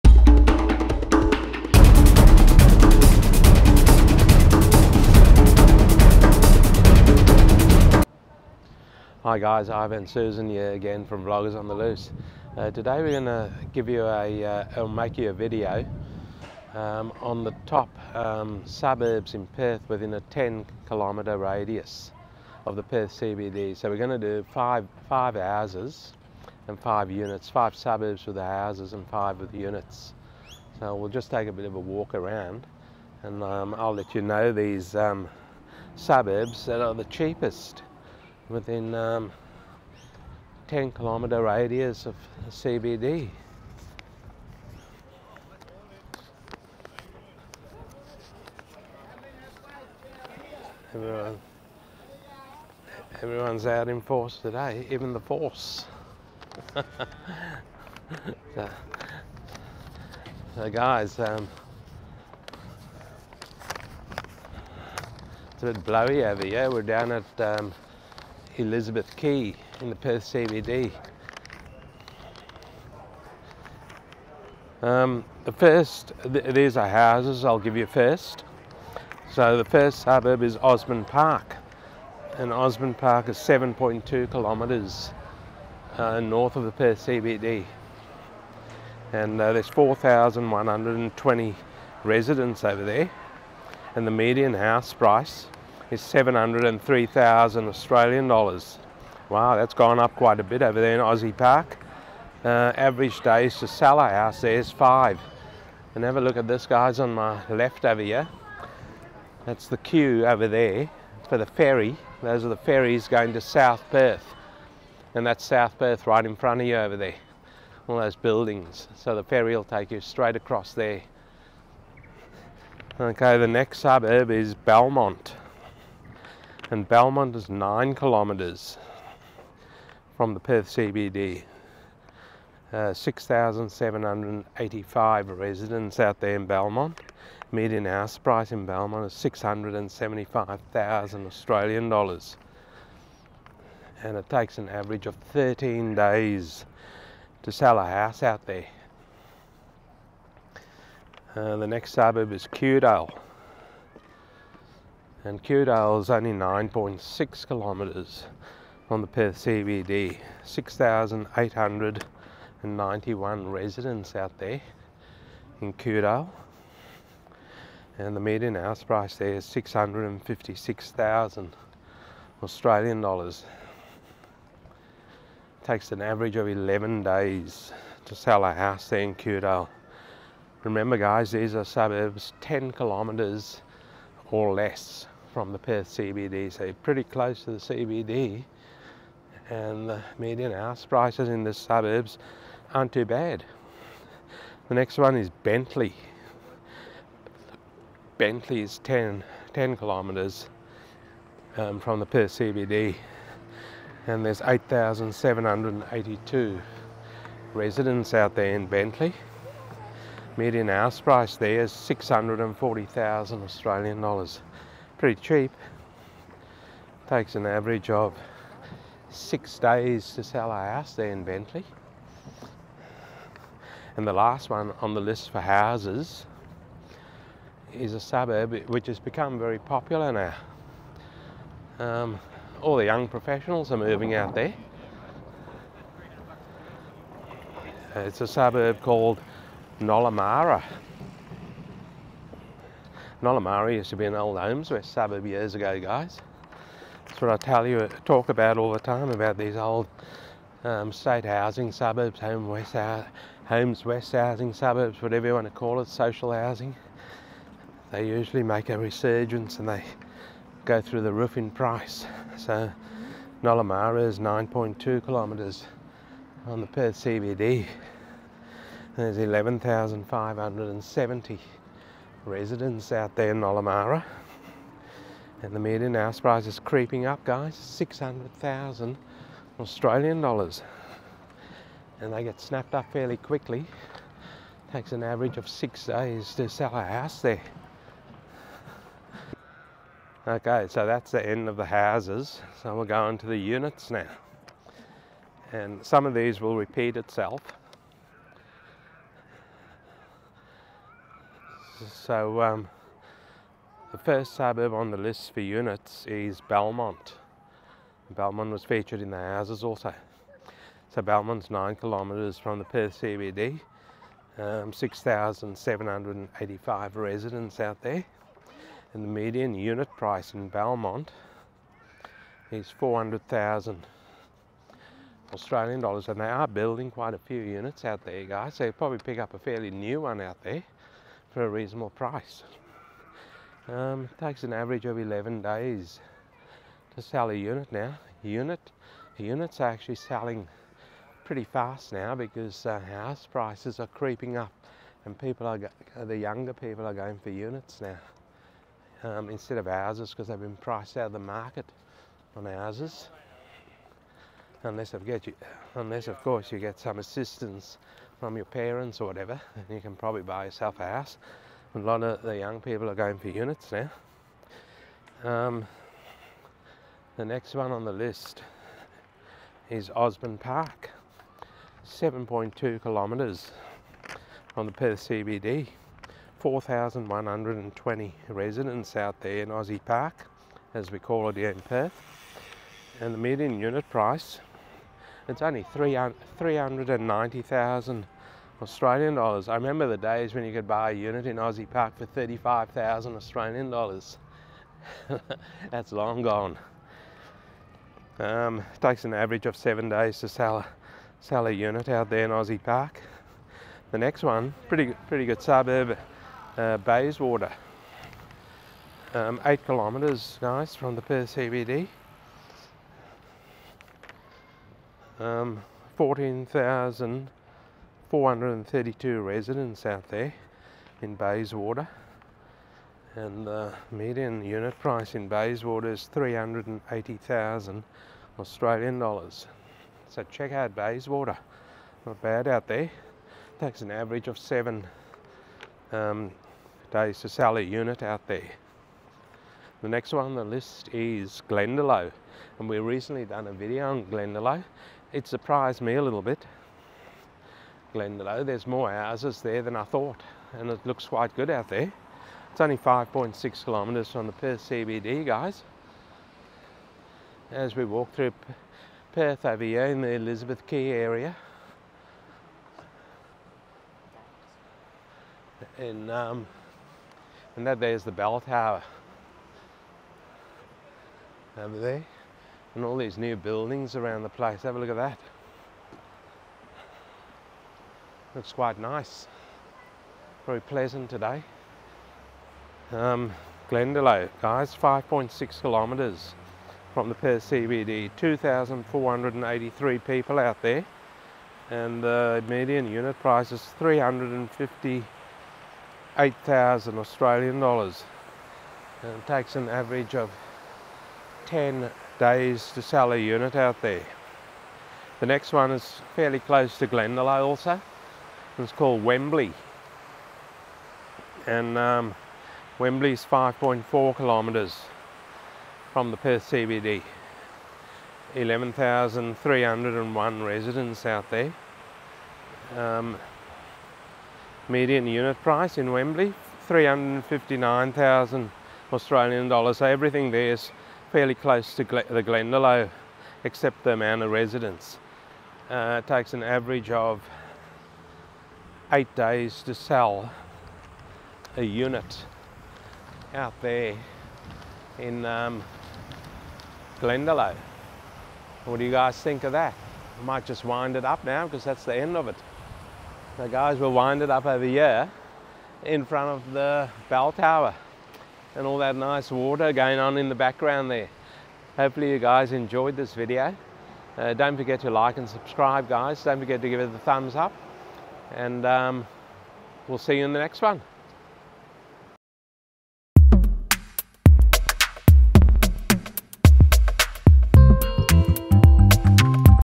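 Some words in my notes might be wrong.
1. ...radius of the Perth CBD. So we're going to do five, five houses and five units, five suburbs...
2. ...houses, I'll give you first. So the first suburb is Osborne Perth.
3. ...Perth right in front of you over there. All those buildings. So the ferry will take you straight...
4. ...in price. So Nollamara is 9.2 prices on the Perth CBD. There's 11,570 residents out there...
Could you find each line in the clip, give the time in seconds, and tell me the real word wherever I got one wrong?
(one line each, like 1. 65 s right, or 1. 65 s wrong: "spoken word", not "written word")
1. 21 s right
2. 76 s wrong: "Park", not "Perth"
3. 115 s right
4. 261 s wrong: "kilometres", not "prices".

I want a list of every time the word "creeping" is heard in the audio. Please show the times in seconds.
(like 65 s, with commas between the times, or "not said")
276 s, 343 s.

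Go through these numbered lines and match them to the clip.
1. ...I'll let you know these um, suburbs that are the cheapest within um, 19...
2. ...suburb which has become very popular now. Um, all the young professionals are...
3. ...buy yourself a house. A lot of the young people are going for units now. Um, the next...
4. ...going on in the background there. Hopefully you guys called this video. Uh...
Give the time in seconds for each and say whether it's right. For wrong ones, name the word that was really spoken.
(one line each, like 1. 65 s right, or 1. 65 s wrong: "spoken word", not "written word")
1. 33 s wrong: "10", not "19"
2. 227 s right
3. 360 s right
4. 559 s wrong: "enjoyed", not "called".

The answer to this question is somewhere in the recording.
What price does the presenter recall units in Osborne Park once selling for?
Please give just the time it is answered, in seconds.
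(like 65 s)
392 s.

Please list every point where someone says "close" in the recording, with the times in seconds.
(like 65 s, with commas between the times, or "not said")
187 s, 506 s, 531 s.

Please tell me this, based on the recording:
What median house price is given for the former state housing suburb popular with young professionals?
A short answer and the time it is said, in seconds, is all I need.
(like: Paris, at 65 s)
$600,000, at 277 s.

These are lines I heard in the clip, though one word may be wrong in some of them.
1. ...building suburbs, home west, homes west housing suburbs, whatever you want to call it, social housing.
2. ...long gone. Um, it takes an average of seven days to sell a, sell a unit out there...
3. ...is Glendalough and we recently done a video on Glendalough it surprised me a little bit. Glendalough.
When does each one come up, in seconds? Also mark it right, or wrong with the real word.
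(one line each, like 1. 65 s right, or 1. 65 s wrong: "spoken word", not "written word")
1. 251 s wrong: "housing", not "building"
2. 395 s right
3. 440 s right.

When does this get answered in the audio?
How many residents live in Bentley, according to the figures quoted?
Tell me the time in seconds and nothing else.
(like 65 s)
204 s.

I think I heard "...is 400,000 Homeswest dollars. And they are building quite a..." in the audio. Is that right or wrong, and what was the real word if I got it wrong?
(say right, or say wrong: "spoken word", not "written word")
wrong: "Australian", not "Homeswest".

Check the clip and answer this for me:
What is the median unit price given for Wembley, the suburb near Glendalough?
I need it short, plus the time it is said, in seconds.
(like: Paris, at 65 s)
$359,000, at 526 s.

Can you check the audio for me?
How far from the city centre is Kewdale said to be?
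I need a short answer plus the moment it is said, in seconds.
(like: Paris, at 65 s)
9.6 kilometres, at 156 s.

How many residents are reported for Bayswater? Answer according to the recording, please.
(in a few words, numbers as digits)
14,432.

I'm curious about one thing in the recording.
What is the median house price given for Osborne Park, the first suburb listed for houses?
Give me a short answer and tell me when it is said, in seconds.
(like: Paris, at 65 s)
$703,000, at 96 s.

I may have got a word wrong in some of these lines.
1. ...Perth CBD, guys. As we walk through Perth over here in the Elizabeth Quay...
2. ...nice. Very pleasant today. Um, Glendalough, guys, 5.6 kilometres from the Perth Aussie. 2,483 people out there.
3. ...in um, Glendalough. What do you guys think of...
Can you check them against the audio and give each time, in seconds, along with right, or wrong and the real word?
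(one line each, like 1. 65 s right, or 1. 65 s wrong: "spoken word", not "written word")
1. 454 s right
2. 478 s wrong: "CBD", not "Aussie"
3. 544 s right.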